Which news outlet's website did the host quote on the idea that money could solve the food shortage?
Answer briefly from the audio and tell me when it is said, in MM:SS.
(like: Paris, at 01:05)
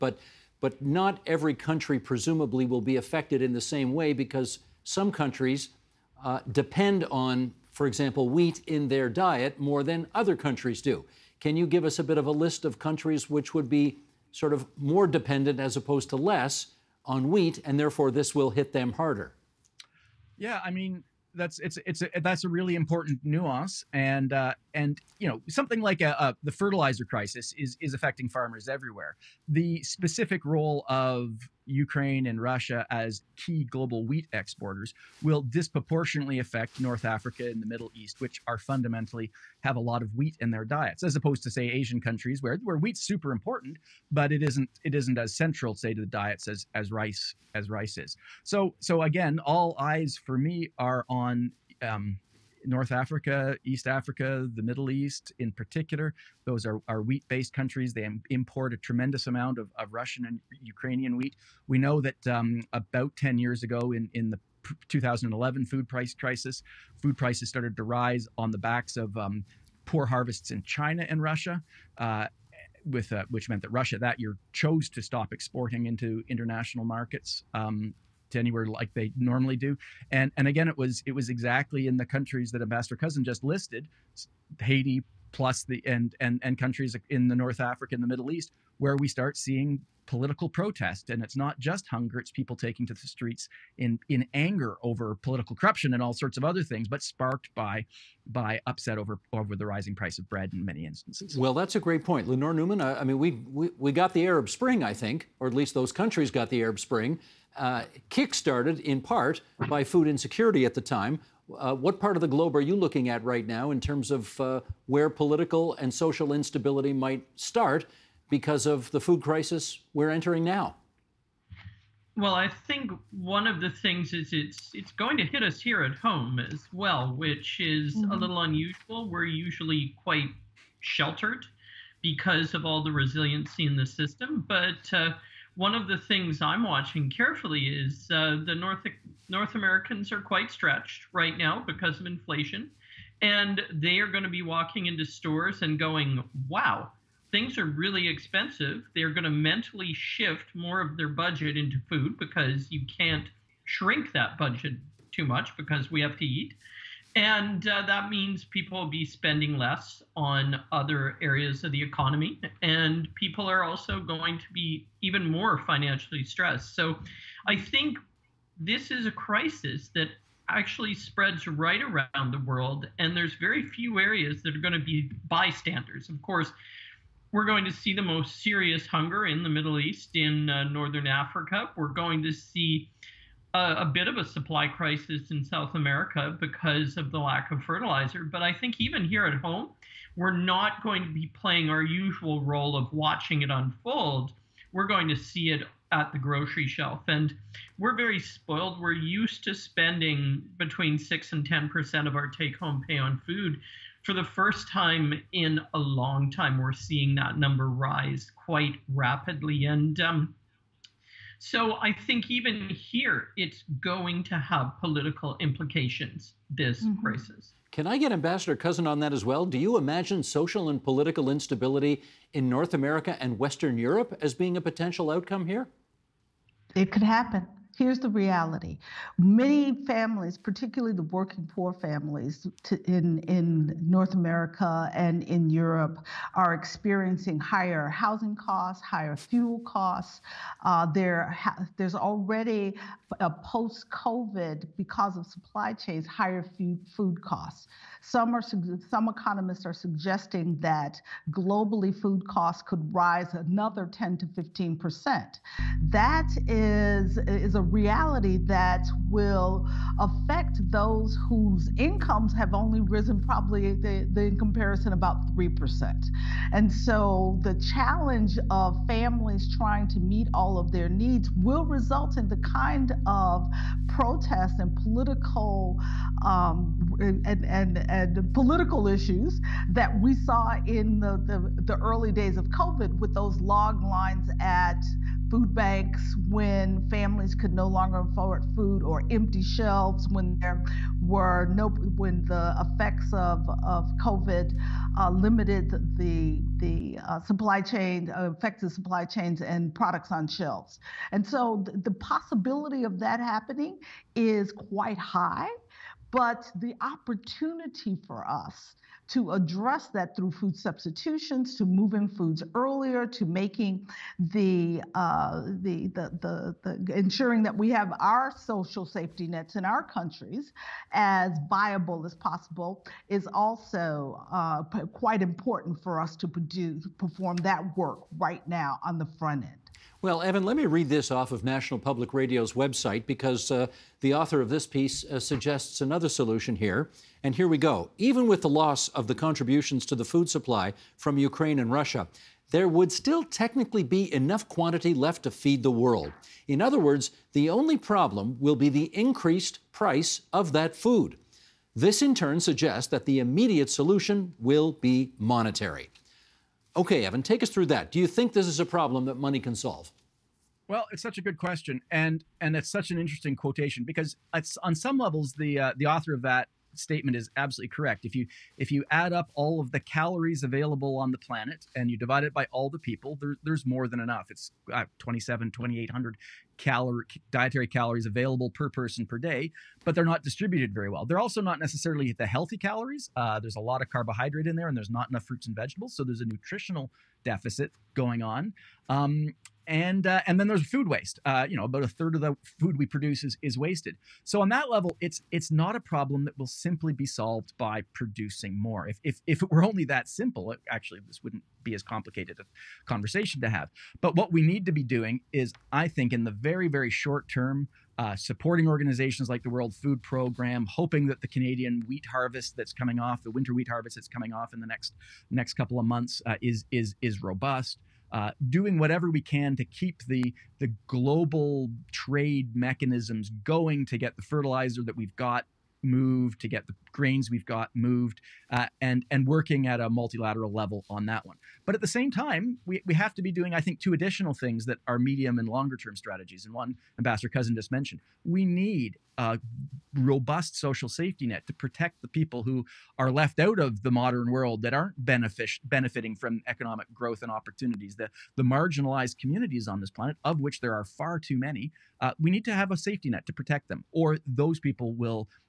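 National Public Radio, at 05:31.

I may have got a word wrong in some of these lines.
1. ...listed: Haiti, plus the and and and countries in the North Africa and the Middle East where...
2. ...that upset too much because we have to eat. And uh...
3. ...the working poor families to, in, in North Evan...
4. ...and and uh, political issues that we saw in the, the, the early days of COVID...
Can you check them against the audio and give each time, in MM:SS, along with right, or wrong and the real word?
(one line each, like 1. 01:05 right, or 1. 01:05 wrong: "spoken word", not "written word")
1. 01:23 right
2. 02:34 wrong: "budget", not "upset"
3. 03:50 wrong: "America", not "Evan"
4. 04:37 right.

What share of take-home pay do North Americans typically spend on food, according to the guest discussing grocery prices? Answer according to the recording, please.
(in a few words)
6 to 10%.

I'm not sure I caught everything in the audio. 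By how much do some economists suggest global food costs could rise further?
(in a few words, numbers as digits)
10 to 15 percent.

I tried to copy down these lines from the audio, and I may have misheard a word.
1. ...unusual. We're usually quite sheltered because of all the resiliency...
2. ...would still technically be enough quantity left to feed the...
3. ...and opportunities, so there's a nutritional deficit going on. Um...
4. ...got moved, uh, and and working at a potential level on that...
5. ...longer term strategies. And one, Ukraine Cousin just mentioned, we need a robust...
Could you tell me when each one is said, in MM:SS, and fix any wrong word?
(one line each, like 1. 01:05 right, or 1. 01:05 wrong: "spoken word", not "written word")
1. 02:08 right
2. 05:42 right
3. 06:25 wrong: "vegetables", not "opportunities"
4. 07:07 wrong: "multilateral", not "potential"
5. 07:15 wrong: "Ambassador", not "Ukraine".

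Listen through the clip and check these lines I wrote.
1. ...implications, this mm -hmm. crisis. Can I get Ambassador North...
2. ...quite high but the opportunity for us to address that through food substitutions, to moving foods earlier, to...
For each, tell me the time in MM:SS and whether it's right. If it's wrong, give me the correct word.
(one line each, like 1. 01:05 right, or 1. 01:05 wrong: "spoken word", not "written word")
1. 03:35 wrong: "Cousin", not "North"
2. 05:04 right.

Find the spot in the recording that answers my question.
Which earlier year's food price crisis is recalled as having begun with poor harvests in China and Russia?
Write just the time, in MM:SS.
01:04.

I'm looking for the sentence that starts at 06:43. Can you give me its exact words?
But what we need to be doing is, I think, in the very very short term.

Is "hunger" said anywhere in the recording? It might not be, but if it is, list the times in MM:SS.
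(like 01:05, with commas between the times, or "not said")
01:31, 02:58.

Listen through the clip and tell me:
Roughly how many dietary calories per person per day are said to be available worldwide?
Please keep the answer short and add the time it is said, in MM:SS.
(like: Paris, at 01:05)
2800, at 06:15.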